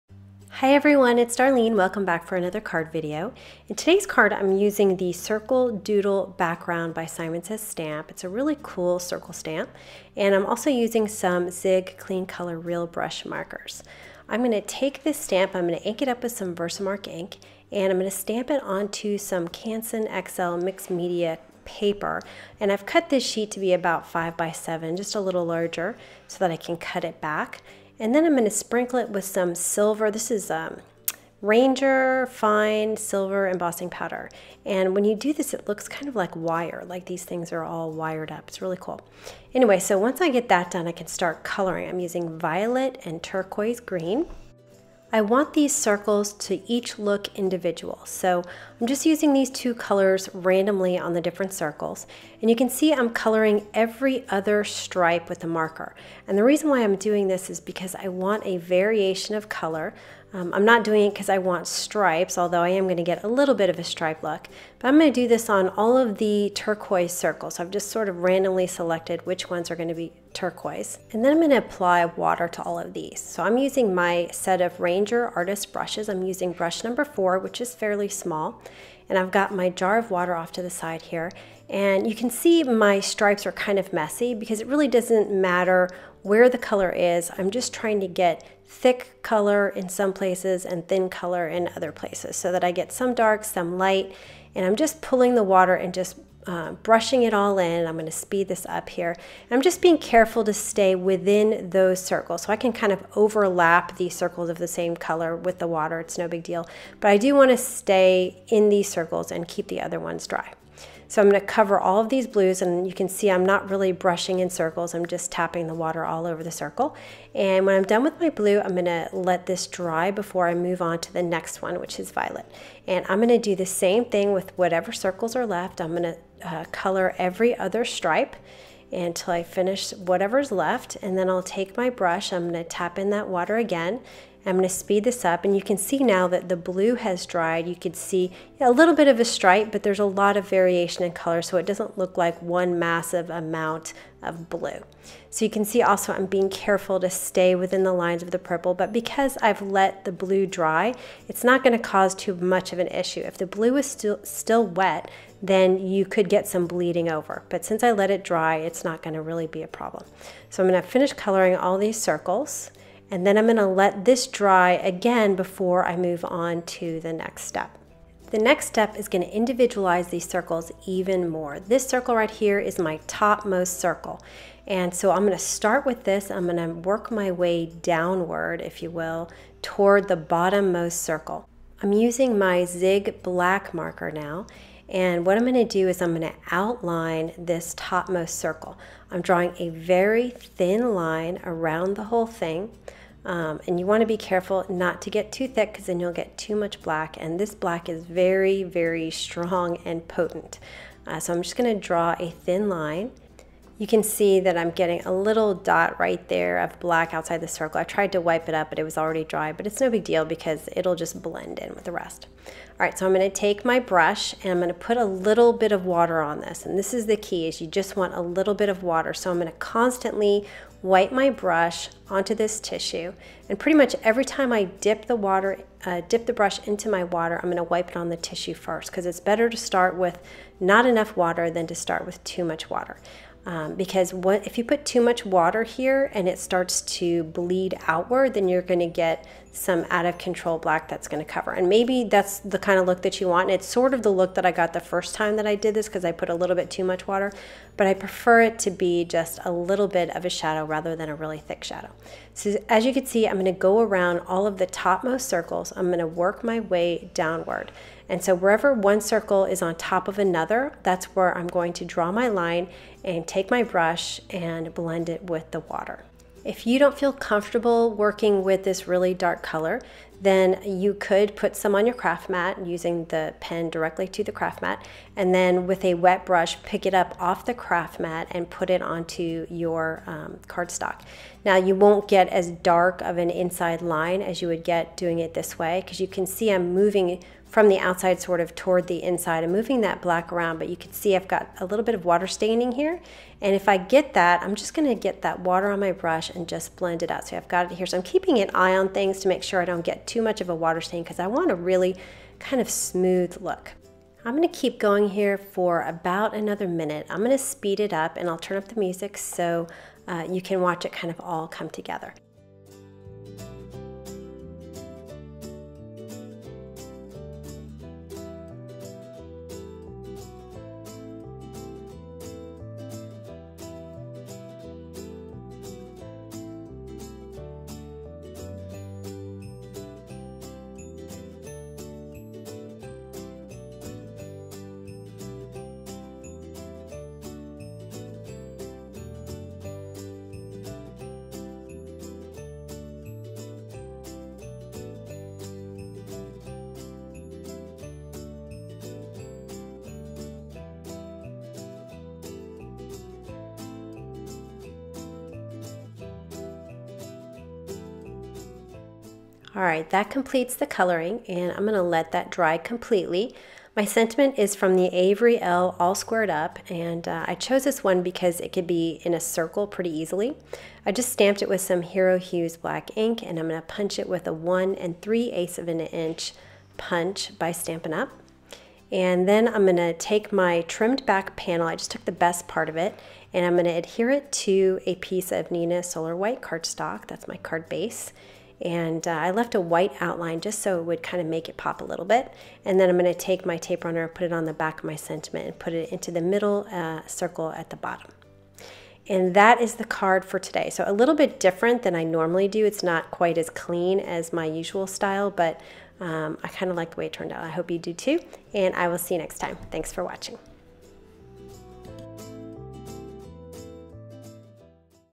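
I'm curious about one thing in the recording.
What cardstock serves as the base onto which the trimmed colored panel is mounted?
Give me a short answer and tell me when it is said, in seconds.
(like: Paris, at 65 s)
Neenah Solar White, at 385 s.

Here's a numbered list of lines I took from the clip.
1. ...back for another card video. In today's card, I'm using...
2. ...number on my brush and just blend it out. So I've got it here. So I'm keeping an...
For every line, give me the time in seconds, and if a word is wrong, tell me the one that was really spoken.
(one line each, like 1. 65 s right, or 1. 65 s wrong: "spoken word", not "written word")
1. 2 s right
2. 295 s wrong: "water", not "number".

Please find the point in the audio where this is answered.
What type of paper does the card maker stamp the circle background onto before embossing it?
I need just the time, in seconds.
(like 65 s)
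19 s.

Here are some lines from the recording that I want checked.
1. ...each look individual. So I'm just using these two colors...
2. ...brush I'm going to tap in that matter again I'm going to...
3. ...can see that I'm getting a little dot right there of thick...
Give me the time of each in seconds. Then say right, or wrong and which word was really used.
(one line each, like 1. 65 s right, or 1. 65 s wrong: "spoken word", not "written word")
1. 46 s right
2. 131 s wrong: "water", not "matter"
3. 203 s wrong: "black", not "thick".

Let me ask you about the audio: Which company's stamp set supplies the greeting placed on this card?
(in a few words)
Avery Elle.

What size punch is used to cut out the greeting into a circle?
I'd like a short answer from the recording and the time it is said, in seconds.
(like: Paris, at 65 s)
1 3/8 inch, at 374 s.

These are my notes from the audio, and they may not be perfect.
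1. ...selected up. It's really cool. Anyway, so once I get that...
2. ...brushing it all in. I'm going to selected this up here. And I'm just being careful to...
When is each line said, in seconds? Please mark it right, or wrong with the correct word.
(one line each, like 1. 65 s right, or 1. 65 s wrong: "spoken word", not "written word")
1. 37 s wrong: "wired", not "selected"
2. 96 s wrong: "speed", not "selected".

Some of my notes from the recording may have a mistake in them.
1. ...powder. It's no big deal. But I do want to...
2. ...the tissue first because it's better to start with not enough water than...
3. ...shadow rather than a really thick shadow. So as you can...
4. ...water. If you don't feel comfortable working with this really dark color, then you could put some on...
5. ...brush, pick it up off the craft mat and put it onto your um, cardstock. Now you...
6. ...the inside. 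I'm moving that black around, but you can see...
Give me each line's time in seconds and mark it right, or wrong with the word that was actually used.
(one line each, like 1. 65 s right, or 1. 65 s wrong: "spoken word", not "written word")
1. 105 s wrong: "water", not "powder"
2. 228 s right
3. 250 s right
4. 265 s right
5. 276 s right
6. 288 s right.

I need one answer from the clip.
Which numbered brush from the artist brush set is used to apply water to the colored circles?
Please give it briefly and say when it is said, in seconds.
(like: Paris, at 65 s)
4, at 76 s.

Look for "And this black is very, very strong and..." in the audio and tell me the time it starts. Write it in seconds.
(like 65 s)
197 s.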